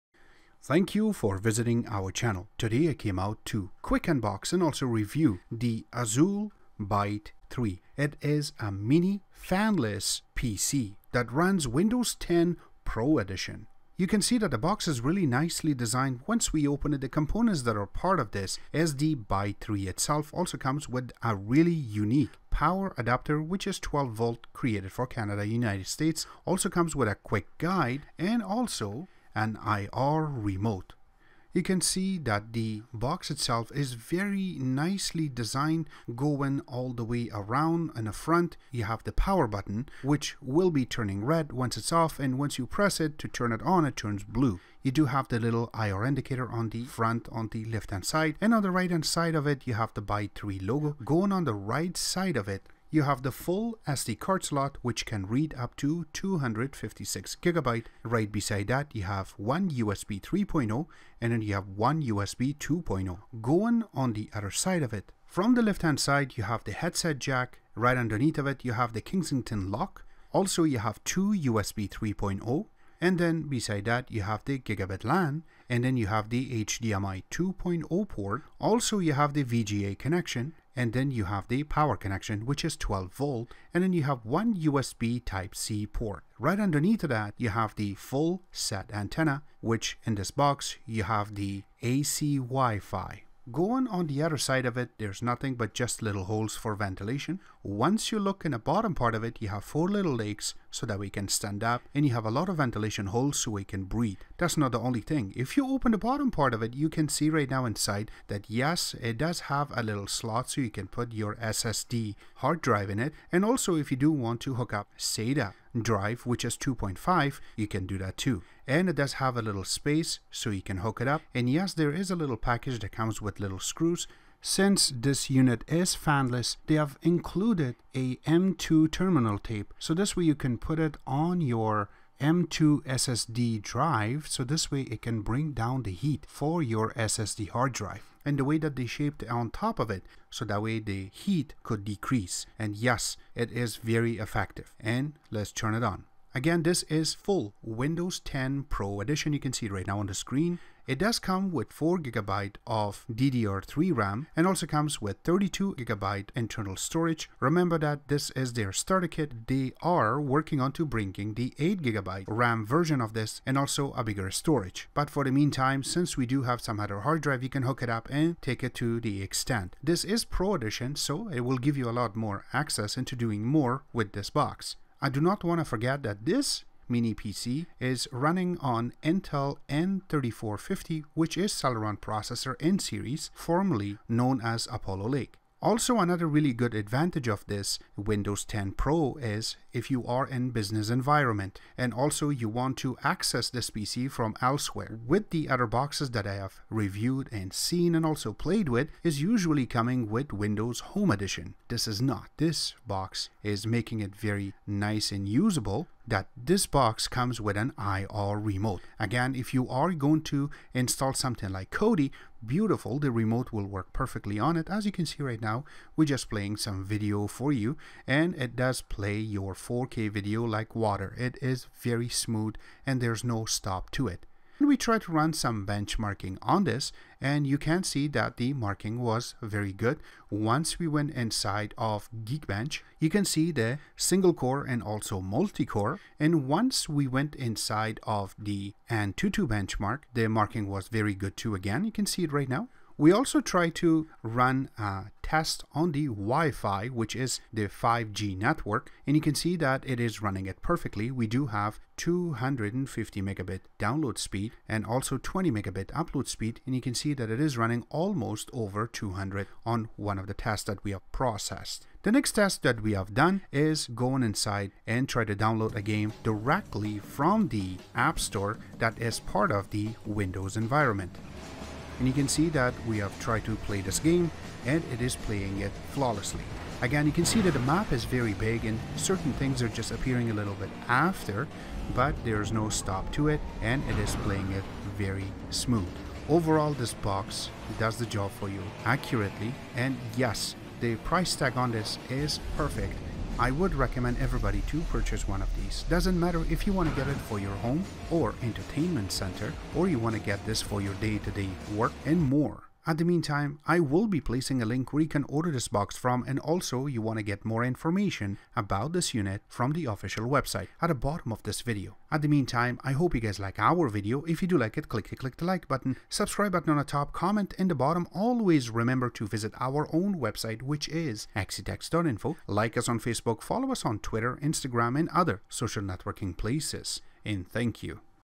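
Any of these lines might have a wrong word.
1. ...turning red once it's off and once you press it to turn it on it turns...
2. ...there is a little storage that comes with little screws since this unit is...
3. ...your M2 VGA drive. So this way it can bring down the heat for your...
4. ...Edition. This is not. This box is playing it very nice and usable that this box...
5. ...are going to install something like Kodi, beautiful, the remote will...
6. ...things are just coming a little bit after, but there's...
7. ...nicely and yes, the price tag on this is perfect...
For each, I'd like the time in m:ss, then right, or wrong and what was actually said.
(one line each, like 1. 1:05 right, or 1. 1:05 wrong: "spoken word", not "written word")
1. 0:40 right
2. 2:01 wrong: "package", not "storage"
3. 2:11 wrong: "SSD", not "VGA"
4. 3:21 wrong: "making", not "playing"
5. 3:29 right
6. 4:39 wrong: "appearing", not "coming"
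7. 4:48 wrong: "accurately", not "nicely".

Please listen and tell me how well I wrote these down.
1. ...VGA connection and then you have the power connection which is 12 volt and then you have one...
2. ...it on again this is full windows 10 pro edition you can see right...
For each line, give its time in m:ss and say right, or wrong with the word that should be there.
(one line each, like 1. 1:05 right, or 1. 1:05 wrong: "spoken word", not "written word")
1. 1:19 right
2. 2:25 right.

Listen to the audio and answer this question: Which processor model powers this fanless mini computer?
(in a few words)
Intel N3450.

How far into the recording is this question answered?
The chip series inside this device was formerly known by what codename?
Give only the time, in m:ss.
3:04.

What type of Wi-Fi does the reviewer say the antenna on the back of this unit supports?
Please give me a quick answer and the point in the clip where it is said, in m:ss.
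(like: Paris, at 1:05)
AC Wi-Fi, at 1:31.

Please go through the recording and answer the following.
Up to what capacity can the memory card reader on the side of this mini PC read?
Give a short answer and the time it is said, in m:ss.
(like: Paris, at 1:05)
256 GB, at 0:56.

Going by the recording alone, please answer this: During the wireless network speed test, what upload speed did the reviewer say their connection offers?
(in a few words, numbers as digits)
20 megabit.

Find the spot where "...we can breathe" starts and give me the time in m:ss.
1:43.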